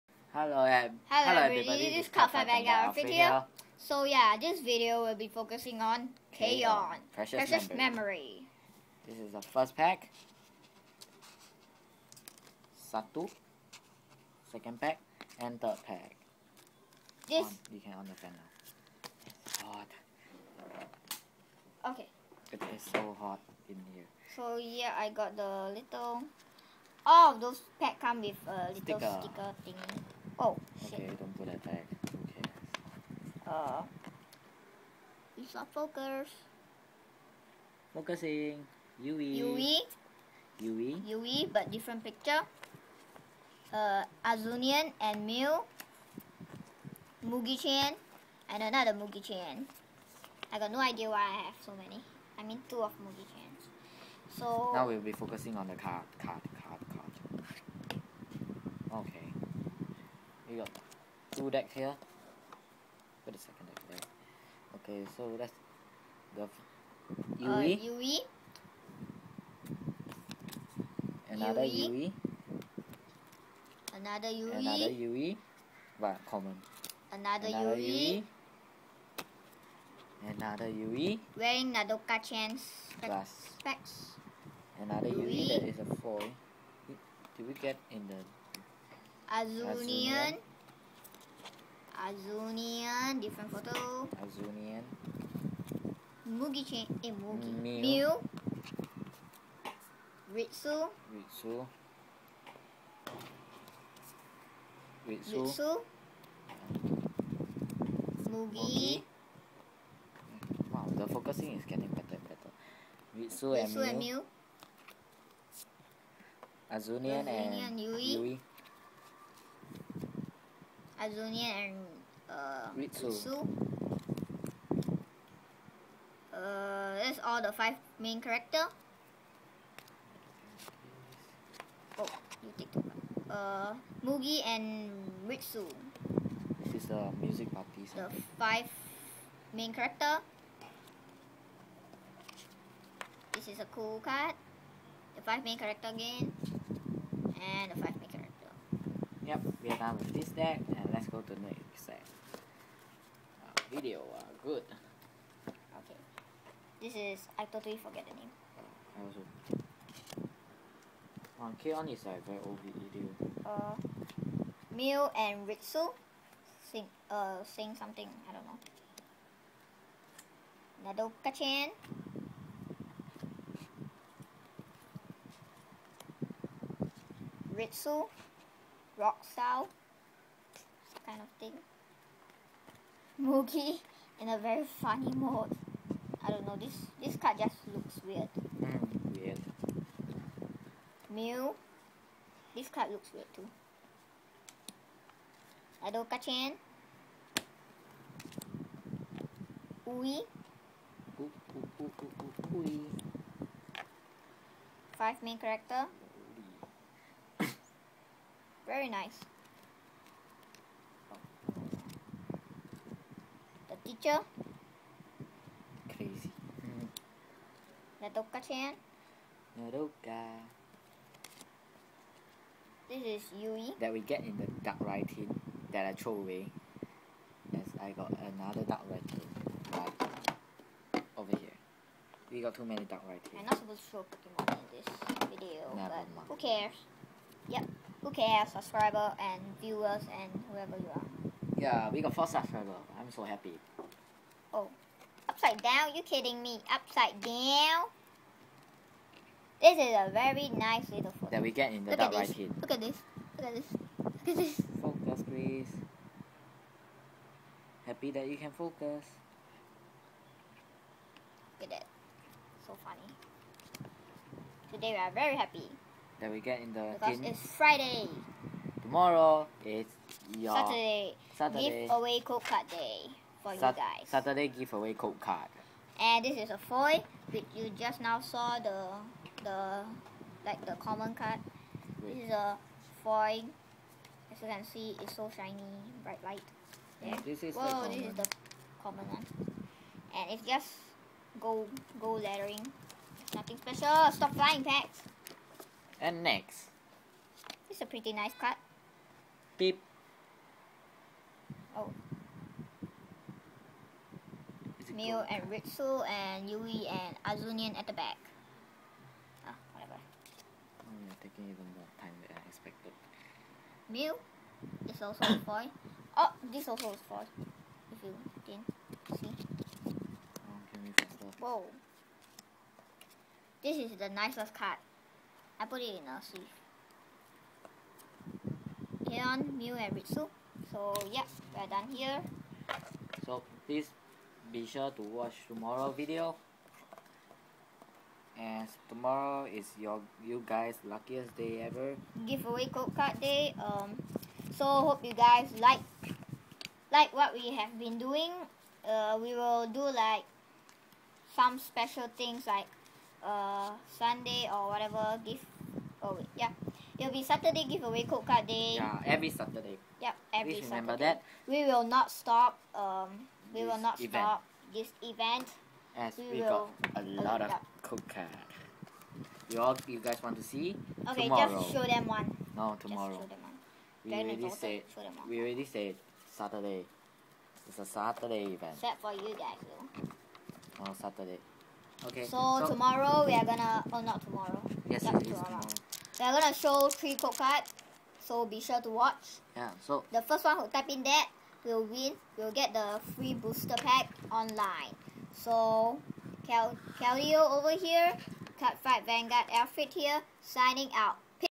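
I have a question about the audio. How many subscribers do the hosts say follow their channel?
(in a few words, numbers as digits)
4.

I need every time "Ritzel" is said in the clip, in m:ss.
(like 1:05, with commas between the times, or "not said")
2:45, 2:57.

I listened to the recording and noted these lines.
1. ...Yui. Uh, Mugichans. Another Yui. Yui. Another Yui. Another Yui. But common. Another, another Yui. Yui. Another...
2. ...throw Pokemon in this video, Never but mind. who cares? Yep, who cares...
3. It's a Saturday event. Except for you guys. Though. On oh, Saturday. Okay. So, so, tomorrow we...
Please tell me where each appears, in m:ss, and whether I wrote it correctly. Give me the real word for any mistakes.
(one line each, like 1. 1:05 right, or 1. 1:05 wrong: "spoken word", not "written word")
1. 1:07 wrong: "Yui", not "Mugichans"
2. 3:53 right
3. 6:17 right.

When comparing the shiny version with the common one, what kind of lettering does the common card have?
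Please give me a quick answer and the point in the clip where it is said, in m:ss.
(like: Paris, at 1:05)
Gold lettering, at 4:51.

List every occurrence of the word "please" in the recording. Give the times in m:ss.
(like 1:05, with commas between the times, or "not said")
4:15, 5:33, 6:00.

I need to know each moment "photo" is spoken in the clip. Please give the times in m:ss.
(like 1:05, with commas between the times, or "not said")
1:33, 4:11.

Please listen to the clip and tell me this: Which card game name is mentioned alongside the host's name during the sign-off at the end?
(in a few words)
Cardfight Vanguard.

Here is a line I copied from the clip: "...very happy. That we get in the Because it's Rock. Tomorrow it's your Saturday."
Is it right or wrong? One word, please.
wrong.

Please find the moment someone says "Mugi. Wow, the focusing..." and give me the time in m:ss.
1:48.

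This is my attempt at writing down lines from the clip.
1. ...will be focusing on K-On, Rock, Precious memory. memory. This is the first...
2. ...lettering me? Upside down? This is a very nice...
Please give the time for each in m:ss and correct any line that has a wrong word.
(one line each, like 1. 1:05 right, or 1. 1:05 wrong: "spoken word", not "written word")
1. 0:05 wrong: "Precious", not "Rock"
2. 4:06 wrong: "kidding", not "lettering".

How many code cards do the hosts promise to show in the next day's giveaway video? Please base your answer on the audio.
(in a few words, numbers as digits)
Three.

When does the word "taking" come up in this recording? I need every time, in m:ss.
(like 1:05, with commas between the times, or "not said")
5:11.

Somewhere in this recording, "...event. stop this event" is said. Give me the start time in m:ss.
6:03.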